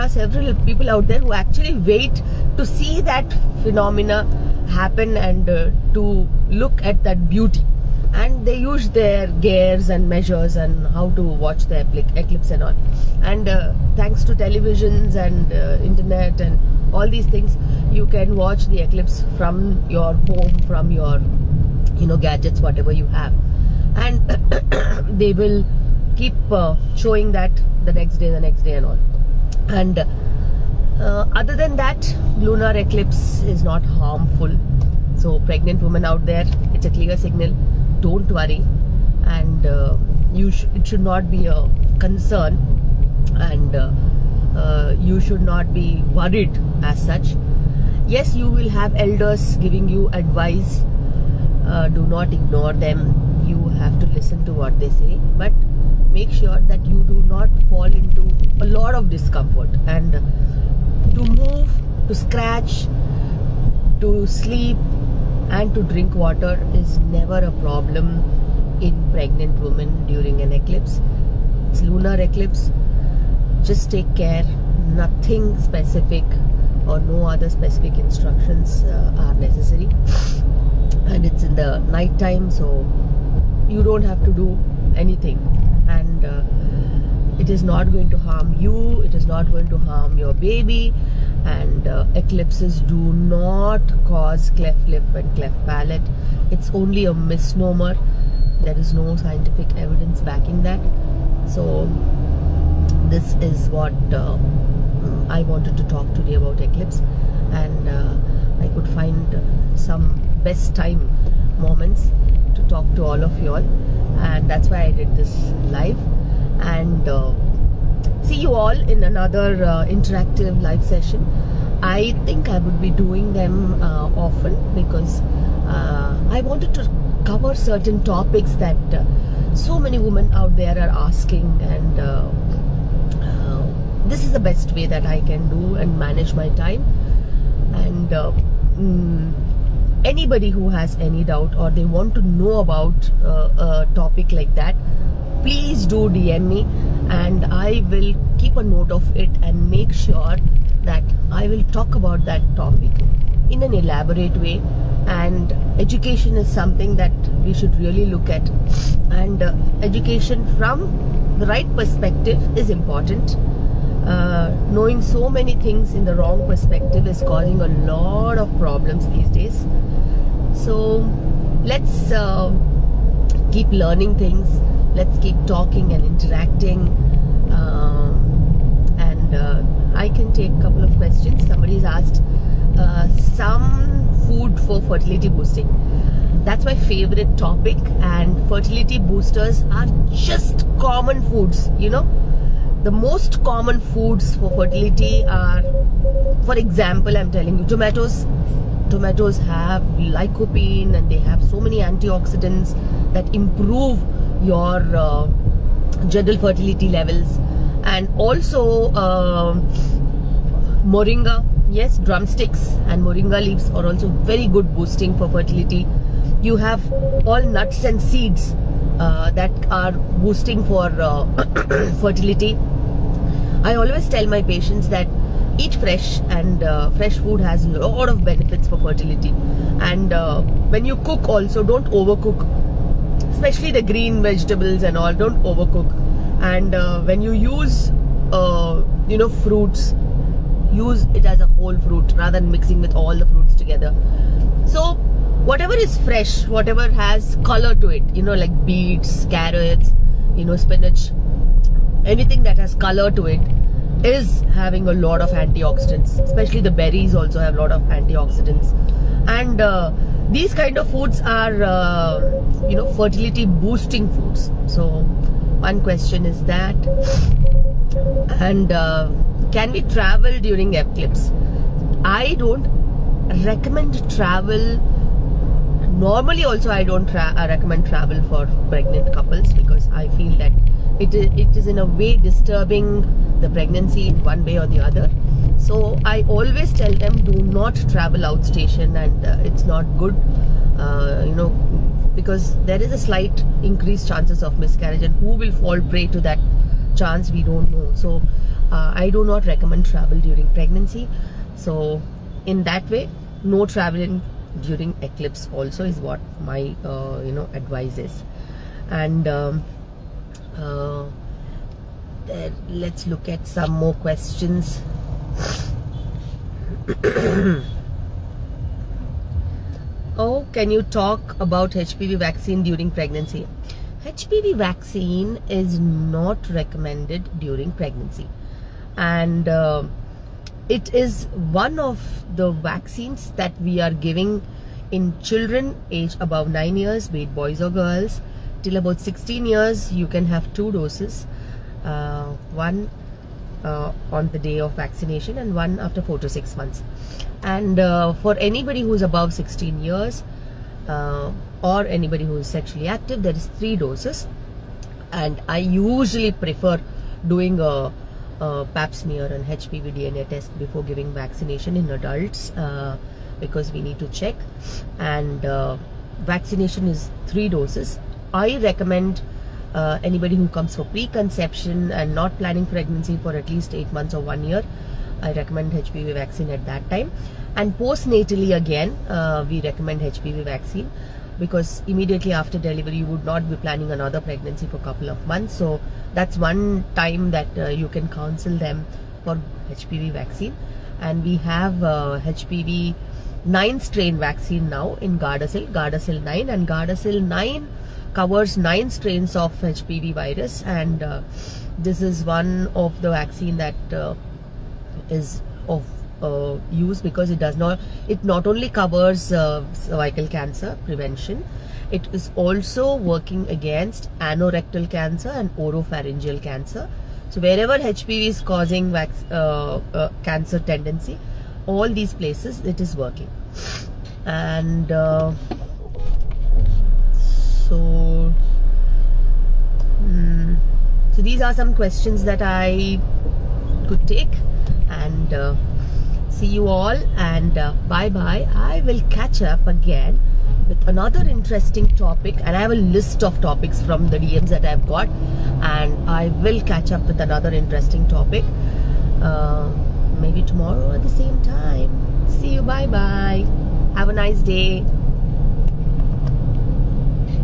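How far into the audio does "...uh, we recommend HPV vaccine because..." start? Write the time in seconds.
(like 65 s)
379 s.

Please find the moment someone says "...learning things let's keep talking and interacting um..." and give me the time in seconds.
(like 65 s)
173 s.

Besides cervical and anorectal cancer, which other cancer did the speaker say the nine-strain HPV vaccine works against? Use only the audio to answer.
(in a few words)
Oropharyngeal cancer.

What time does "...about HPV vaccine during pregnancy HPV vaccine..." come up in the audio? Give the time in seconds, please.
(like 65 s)
321 s.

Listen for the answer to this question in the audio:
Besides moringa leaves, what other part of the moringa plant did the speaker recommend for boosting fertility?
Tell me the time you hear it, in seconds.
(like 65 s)
212 s.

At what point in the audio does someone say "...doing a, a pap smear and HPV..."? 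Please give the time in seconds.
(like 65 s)
357 s.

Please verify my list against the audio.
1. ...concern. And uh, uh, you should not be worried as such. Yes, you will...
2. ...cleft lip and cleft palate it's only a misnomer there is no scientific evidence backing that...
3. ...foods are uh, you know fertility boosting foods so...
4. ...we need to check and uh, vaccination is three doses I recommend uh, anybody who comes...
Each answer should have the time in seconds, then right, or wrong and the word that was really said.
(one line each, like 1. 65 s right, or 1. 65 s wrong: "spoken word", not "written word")
1. 41 s right
2. 94 s right
3. 260 s right
4. 363 s right.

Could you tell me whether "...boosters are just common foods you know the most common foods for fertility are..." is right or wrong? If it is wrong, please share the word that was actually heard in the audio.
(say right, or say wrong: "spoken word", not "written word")
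right.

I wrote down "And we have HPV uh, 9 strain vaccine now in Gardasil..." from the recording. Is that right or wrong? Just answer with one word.
right.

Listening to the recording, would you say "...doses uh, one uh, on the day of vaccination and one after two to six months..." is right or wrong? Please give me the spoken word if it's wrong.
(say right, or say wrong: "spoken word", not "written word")
wrong: "four", not "two".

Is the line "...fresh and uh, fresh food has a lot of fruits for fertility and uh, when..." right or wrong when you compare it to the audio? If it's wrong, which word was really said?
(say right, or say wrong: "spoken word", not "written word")
wrong: "benefits", not "fruits".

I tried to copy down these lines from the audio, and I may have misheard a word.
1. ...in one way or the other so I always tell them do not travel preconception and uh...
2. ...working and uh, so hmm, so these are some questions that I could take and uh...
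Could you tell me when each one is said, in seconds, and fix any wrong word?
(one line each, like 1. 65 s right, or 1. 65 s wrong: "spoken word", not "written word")
1. 284 s wrong: "outstation", not "preconception"
2. 422 s right.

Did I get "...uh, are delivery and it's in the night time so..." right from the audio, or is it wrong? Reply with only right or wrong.
wrong.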